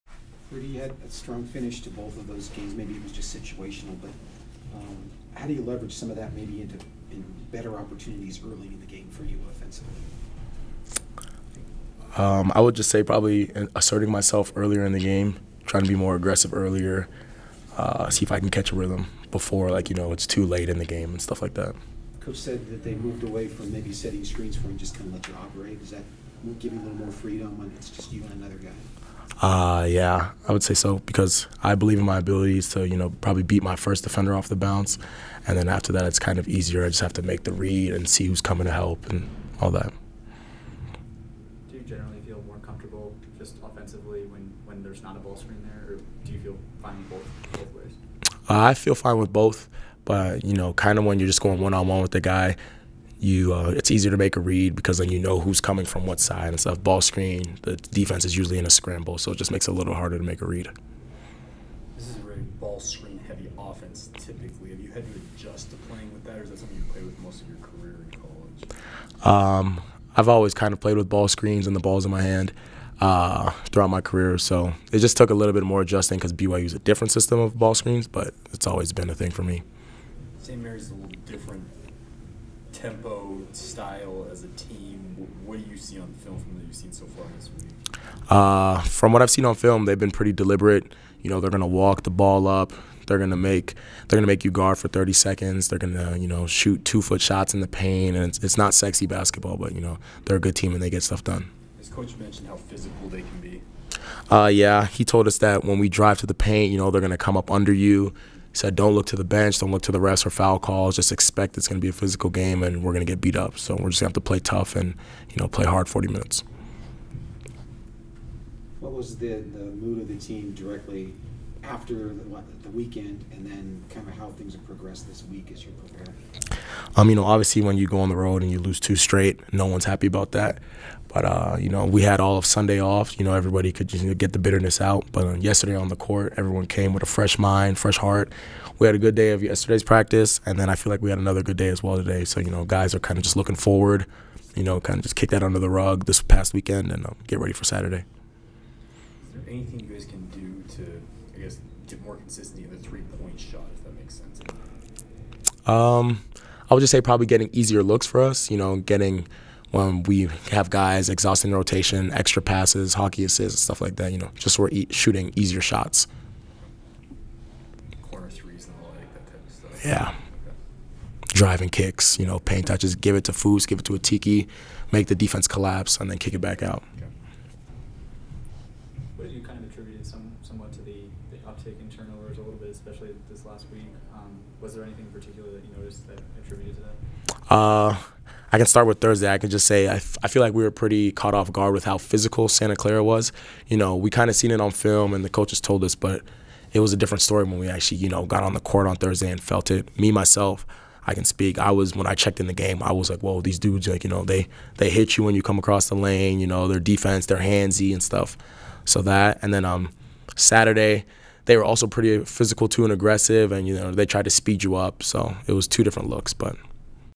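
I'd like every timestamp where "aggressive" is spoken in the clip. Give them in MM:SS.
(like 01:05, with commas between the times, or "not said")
00:16, 03:32.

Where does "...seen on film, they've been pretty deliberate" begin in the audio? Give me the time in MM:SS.
01:29.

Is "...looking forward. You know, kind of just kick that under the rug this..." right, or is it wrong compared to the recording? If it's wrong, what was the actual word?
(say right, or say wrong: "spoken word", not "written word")
right.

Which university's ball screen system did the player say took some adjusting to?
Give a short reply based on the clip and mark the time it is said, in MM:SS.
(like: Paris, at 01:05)
BYU, at 01:16.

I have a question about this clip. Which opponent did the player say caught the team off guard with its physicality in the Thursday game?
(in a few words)
Santa Clara.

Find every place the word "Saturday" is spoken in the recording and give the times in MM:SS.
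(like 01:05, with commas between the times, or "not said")
02:27, 03:30.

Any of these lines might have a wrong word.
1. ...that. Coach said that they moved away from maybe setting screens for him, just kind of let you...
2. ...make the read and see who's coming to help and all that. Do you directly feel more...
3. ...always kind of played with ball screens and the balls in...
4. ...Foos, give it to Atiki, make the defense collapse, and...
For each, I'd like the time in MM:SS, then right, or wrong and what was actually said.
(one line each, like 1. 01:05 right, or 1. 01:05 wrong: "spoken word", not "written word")
1. 00:21 right
2. 00:37 wrong: "generally", not "directly"
3. 01:10 right
4. 02:53 right.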